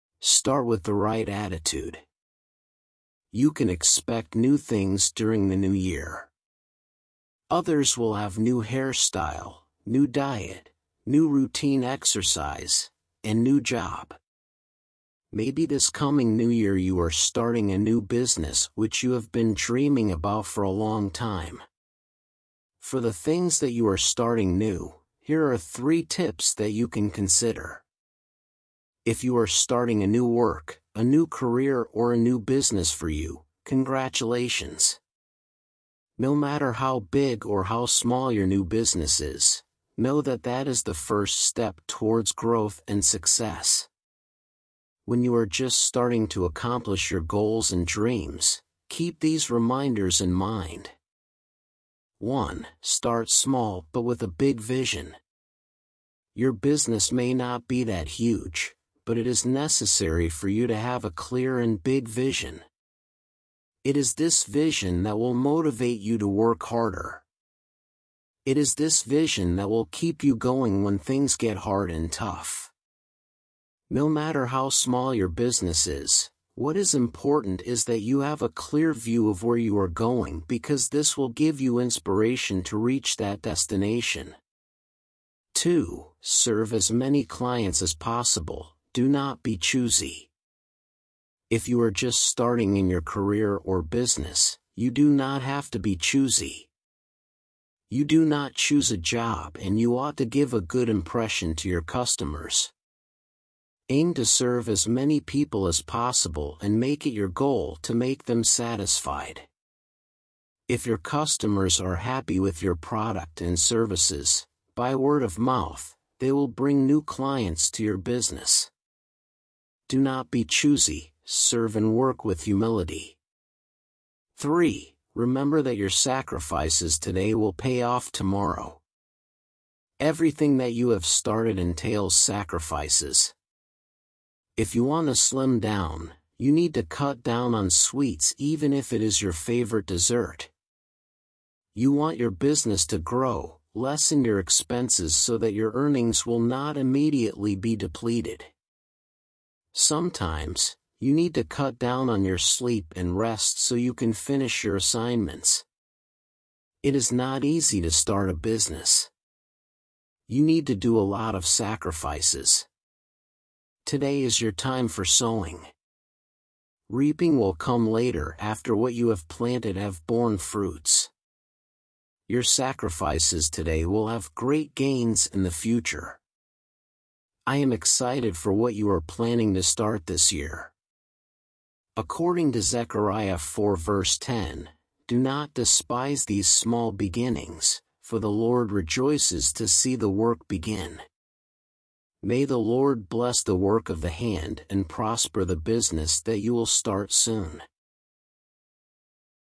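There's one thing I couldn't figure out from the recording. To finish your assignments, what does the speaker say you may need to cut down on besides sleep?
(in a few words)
Rest.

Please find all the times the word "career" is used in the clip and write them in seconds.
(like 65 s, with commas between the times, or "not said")
31 s, 93 s.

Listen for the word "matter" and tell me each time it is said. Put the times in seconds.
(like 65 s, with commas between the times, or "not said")
36 s, 74 s.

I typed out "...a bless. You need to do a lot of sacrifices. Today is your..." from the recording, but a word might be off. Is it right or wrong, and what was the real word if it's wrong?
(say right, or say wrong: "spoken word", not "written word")
wrong: "business", not "bless".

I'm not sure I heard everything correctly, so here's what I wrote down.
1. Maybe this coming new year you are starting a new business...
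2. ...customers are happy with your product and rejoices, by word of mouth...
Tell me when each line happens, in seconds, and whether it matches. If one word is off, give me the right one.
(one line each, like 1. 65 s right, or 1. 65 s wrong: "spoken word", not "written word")
1. 15 s right
2. 110 s wrong: "services", not "rejoices".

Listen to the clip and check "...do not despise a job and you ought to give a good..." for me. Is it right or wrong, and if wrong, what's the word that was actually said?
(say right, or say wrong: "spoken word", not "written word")
wrong: "choose", not "despise".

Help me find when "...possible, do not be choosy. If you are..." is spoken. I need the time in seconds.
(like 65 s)
87 s.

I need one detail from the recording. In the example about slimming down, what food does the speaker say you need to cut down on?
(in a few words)
Sweets.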